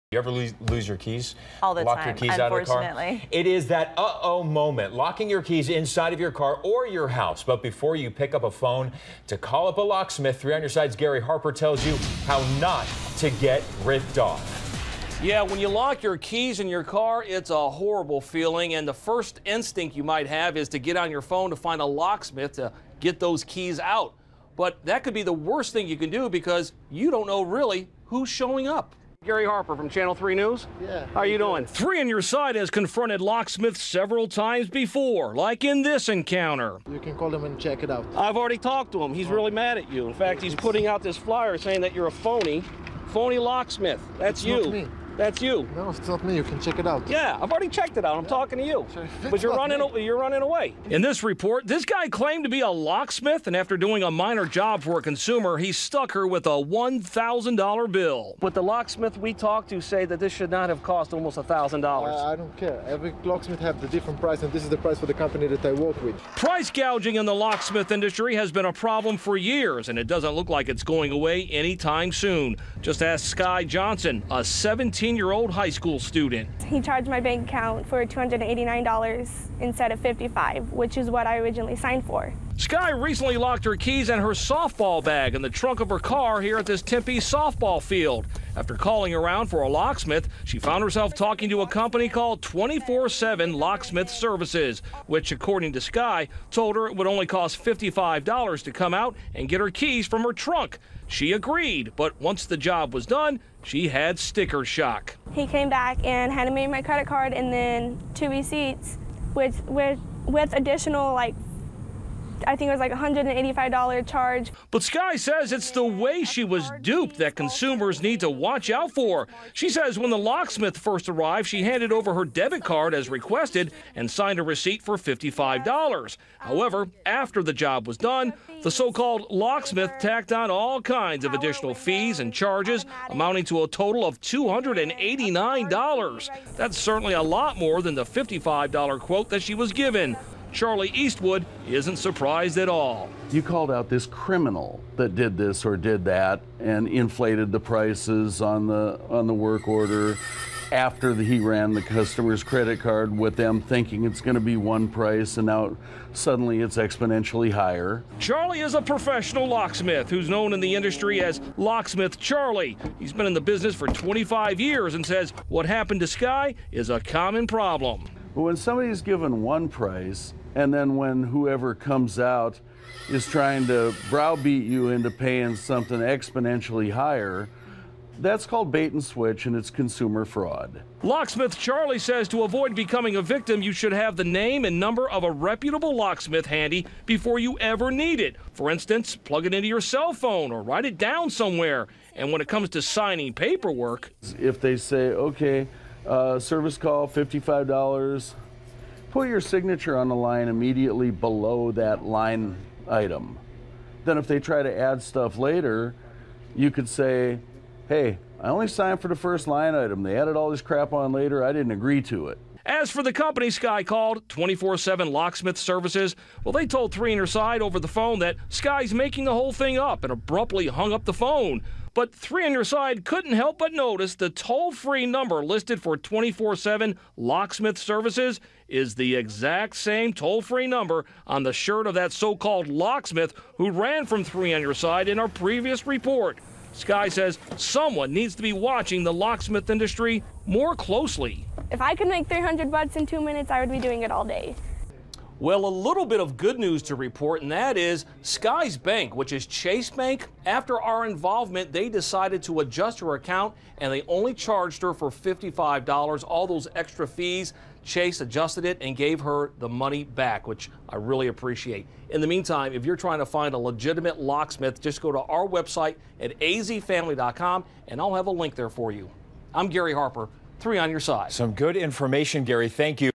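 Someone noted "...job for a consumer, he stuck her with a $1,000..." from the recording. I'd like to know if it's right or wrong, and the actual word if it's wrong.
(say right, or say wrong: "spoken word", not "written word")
right.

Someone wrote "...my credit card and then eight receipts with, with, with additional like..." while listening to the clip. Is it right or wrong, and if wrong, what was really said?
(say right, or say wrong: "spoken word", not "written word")
wrong: "two", not "eight".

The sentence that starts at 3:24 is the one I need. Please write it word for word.
Then if they try to add stuff later, you could say, hey, I only signed for the first line item.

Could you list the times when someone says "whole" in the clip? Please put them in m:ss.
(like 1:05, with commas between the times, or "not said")
3:39.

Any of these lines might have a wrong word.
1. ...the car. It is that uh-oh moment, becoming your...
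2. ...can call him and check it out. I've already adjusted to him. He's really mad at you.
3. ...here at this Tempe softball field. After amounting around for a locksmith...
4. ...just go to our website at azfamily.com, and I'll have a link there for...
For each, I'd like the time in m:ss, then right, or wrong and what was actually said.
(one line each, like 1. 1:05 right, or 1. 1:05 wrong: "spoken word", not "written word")
1. 0:02 wrong: "locking", not "becoming"
2. 0:36 wrong: "talked", not "adjusted"
3. 1:26 wrong: "calling", not "amounting"
4. 4:24 right.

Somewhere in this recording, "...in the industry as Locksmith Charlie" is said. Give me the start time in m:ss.
2:40.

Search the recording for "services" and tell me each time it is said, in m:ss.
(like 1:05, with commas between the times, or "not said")
1:34, 3:16, 3:35, 3:47.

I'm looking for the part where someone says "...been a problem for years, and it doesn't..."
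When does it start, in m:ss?
1:08.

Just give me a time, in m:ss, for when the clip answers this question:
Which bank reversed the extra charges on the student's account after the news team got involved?
4:09.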